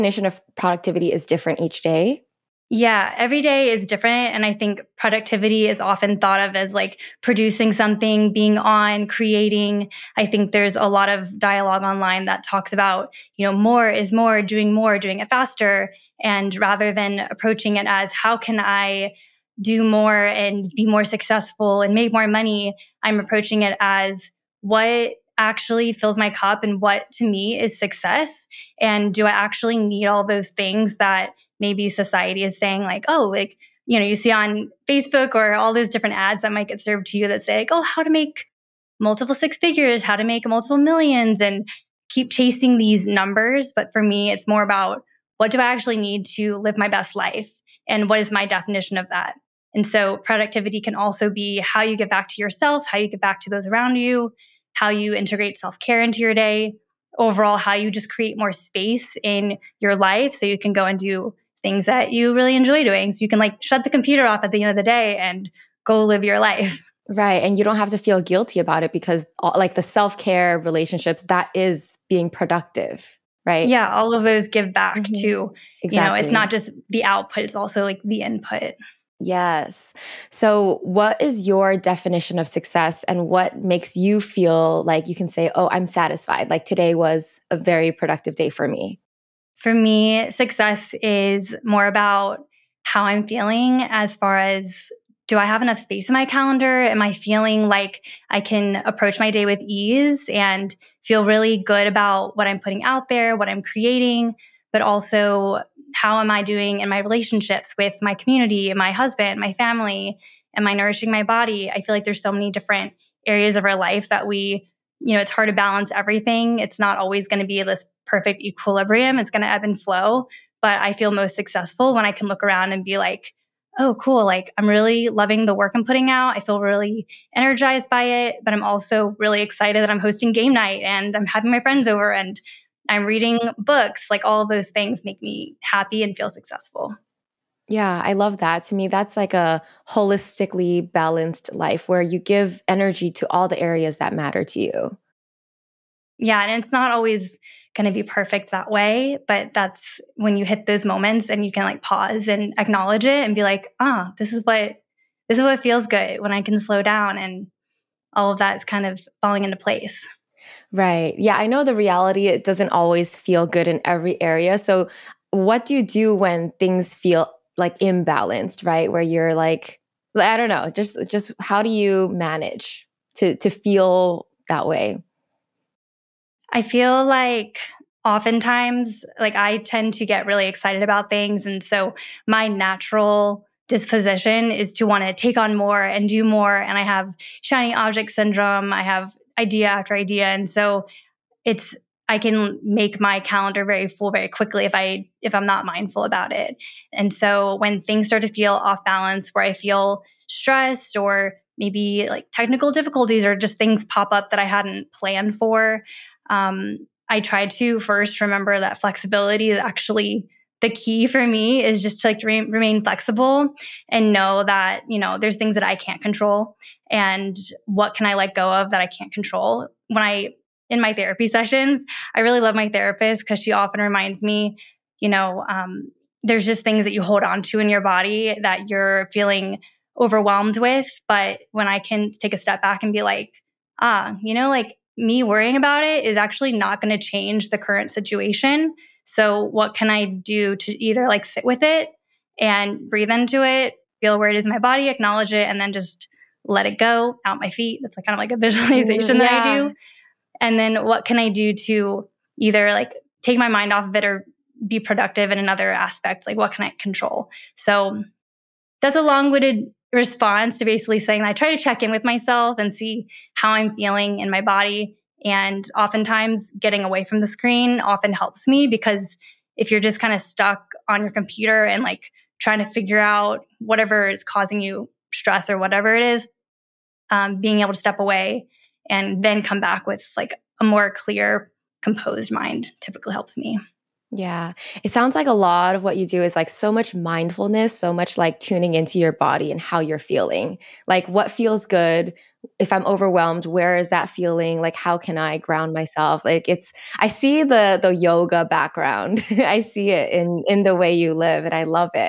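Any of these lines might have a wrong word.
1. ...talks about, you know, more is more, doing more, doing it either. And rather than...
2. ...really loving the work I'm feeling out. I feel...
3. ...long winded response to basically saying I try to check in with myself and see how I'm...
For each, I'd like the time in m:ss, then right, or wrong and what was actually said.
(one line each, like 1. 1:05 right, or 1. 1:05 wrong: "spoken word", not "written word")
1. 0:12 wrong: "faster", not "either"
2. 2:04 wrong: "putting", not "feeling"
3. 4:19 right.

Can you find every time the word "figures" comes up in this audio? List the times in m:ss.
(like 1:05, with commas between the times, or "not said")
0:39, 4:32.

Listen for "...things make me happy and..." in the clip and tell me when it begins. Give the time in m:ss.
2:14.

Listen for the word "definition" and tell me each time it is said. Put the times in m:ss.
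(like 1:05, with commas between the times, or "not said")
0:48, 1:21.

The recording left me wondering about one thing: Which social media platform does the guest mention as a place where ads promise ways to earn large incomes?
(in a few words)
Facebook.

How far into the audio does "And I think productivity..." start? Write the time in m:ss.
0:04.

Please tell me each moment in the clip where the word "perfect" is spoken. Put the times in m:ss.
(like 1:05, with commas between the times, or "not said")
1:58, 2:28.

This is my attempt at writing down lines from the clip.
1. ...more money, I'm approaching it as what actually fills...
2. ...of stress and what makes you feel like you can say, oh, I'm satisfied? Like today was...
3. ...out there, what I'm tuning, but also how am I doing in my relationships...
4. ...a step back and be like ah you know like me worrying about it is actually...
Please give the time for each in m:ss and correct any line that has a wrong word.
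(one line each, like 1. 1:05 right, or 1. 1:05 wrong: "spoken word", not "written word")
1. 0:22 right
2. 1:22 wrong: "success", not "stress"
3. 1:42 wrong: "creating", not "tuning"
4. 3:52 right.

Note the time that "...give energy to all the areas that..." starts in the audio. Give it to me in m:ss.
2:22.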